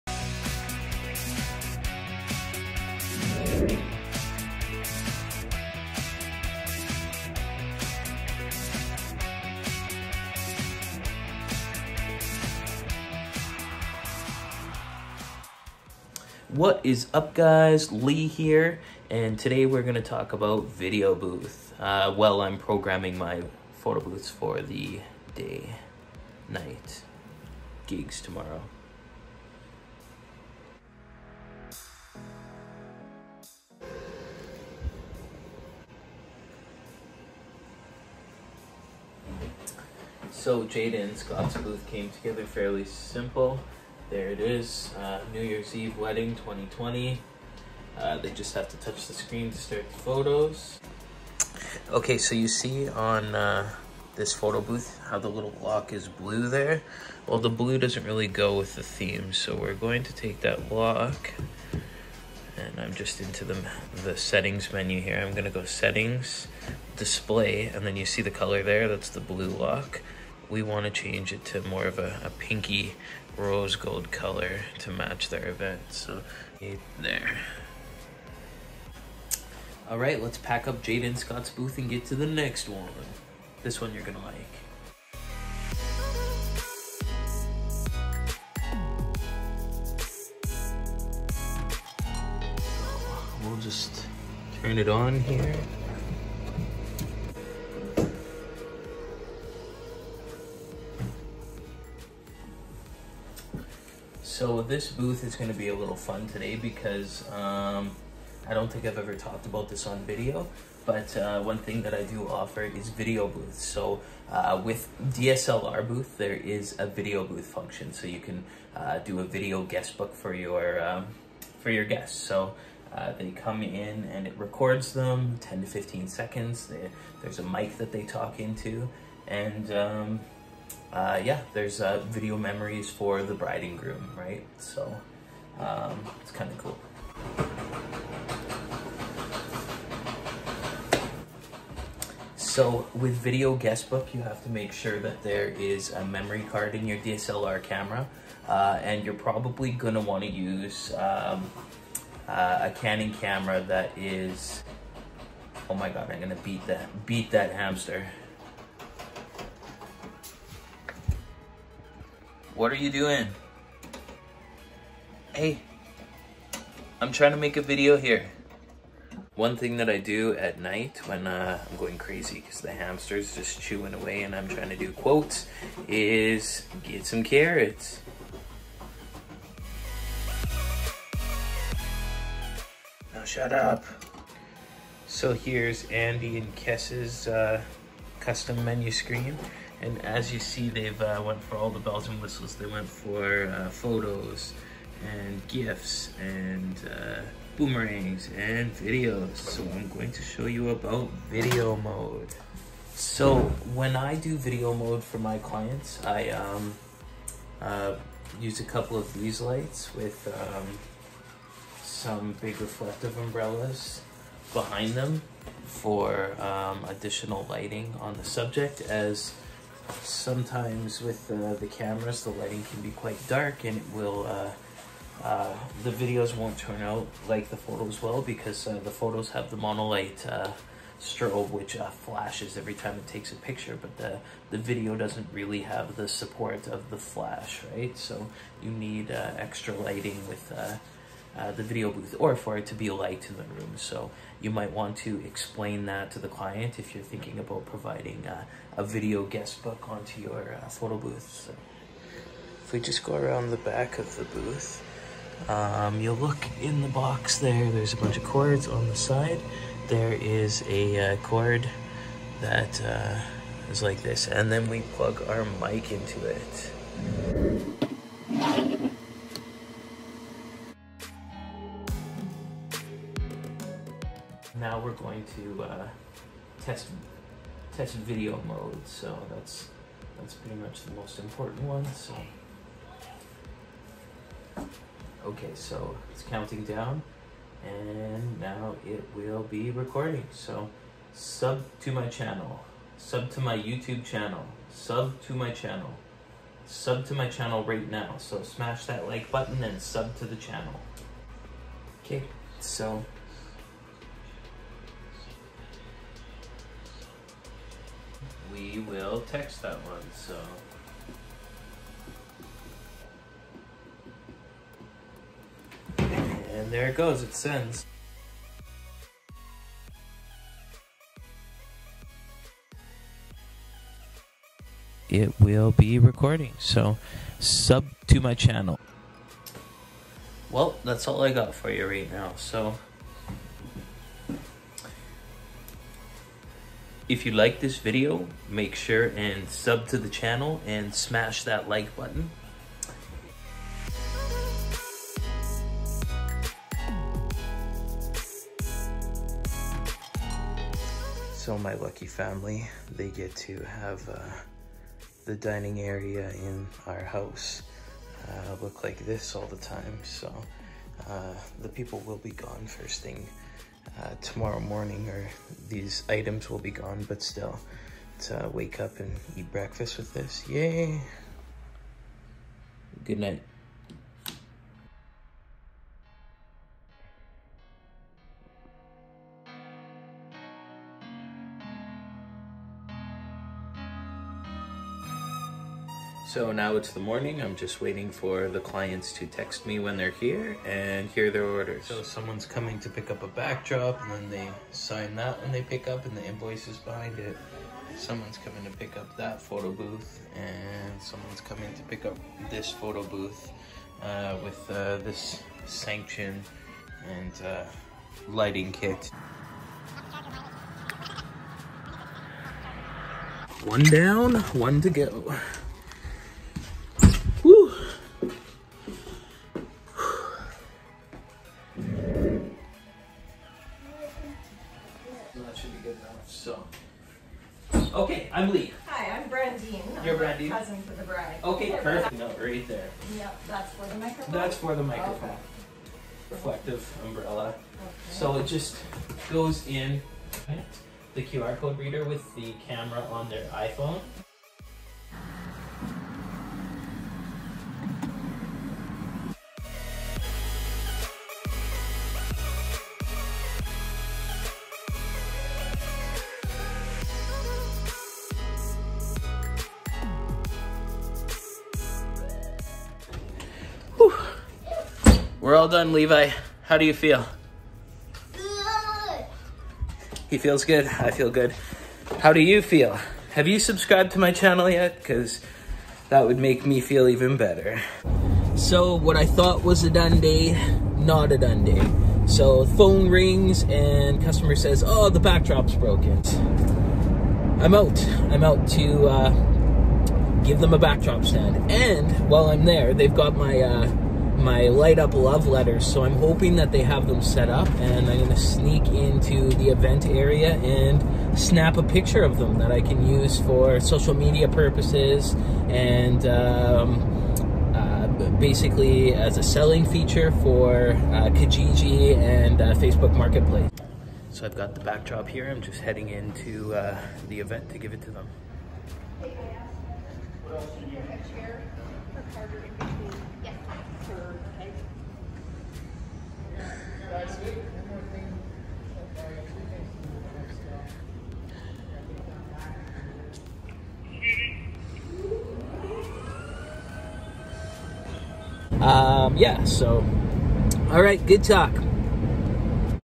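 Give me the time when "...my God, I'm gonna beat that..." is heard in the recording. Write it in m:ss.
2:35.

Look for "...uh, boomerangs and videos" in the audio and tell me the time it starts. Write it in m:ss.
3:16.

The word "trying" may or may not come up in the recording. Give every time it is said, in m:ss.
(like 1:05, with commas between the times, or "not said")
2:47, 2:54.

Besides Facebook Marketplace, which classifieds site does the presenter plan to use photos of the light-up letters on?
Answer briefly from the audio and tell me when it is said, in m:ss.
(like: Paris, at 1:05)
Kijiji, at 8:31.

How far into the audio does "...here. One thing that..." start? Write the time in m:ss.
2:47.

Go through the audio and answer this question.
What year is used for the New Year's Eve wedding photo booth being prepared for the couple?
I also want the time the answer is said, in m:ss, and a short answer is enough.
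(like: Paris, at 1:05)
2020, at 0:46.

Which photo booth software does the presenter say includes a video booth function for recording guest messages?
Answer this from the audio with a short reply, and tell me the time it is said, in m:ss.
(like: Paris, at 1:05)
DSLR booth, at 1:55.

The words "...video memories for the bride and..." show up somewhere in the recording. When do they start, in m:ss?
2:12.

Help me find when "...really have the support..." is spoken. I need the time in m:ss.
3:55.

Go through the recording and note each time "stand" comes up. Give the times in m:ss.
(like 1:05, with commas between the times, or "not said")
8:11.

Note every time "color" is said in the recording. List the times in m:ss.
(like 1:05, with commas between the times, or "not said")
1:08, 1:14.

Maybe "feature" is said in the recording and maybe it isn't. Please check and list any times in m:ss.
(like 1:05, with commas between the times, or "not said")
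8:29.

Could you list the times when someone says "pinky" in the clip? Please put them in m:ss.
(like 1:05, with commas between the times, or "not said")
1:12.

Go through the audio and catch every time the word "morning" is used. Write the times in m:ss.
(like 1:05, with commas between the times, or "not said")
6:04, 6:27.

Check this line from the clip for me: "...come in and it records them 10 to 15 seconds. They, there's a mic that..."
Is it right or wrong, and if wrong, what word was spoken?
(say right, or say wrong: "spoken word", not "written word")
right.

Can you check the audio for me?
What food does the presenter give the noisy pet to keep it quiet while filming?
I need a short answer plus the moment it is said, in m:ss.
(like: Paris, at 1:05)
Carrots, at 2:57.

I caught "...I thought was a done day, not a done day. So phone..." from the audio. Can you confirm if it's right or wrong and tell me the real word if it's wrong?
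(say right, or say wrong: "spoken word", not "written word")
right.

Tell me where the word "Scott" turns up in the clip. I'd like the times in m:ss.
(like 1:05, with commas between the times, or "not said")
0:41, 1:21.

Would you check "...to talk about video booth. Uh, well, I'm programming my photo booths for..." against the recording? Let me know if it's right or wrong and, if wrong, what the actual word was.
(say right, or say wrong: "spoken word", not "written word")
right.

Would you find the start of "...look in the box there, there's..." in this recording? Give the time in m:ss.
4:16.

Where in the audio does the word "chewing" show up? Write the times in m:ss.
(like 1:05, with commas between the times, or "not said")
2:53.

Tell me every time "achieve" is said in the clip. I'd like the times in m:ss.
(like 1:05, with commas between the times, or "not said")
not said.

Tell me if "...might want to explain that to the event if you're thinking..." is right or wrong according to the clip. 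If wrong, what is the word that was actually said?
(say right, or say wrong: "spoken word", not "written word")
wrong: "client", not "event".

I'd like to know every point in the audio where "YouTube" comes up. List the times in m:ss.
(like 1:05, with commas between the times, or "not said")
4:53.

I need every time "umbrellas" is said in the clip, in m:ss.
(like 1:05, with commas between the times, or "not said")
3:33, 7:17.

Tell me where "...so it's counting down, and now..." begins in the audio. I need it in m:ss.
4:45.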